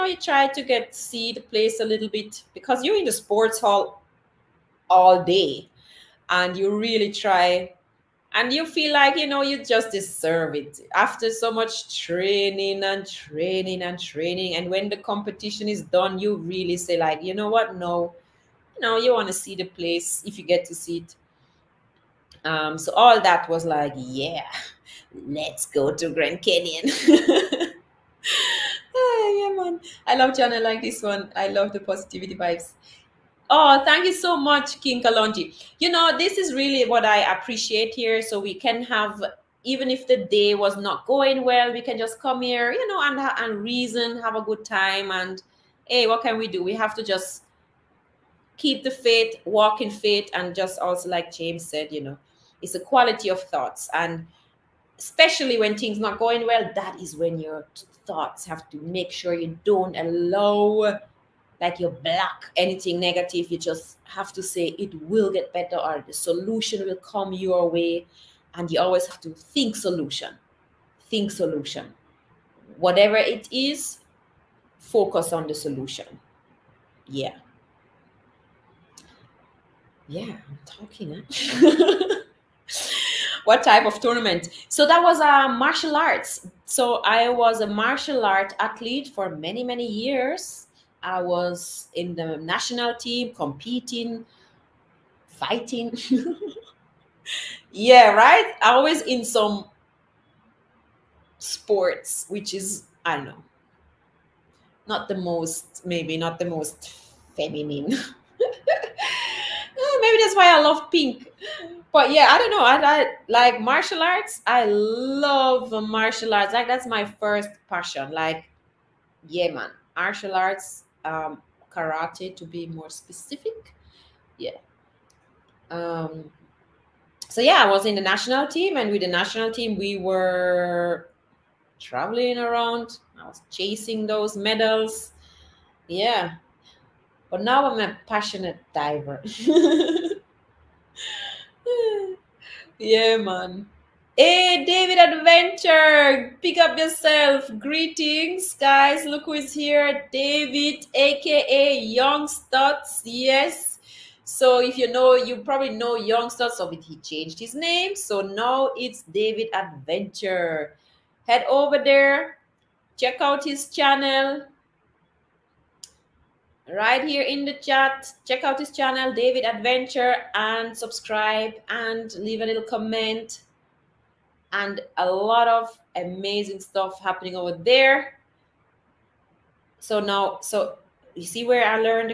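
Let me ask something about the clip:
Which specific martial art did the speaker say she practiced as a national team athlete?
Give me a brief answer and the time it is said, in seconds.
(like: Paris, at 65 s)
Karate, at 121 s.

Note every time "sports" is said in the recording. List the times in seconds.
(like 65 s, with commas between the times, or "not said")
3 s, 101 s.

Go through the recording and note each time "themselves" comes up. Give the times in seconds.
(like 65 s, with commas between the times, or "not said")
not said.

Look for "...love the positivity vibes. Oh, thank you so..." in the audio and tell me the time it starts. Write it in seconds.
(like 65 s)
31 s.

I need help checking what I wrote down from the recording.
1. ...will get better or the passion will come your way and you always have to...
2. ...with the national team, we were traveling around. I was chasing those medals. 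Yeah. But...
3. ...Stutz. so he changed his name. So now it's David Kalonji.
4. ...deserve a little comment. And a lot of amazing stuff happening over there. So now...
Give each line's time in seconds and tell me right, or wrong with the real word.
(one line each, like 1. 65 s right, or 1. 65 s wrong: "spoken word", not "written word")
1. 65 s wrong: "solution", not "passion"
2. 128 s right
3. 156 s wrong: "Adventure", not "Kalonji"
4. 172 s wrong: "leave", not "deserve".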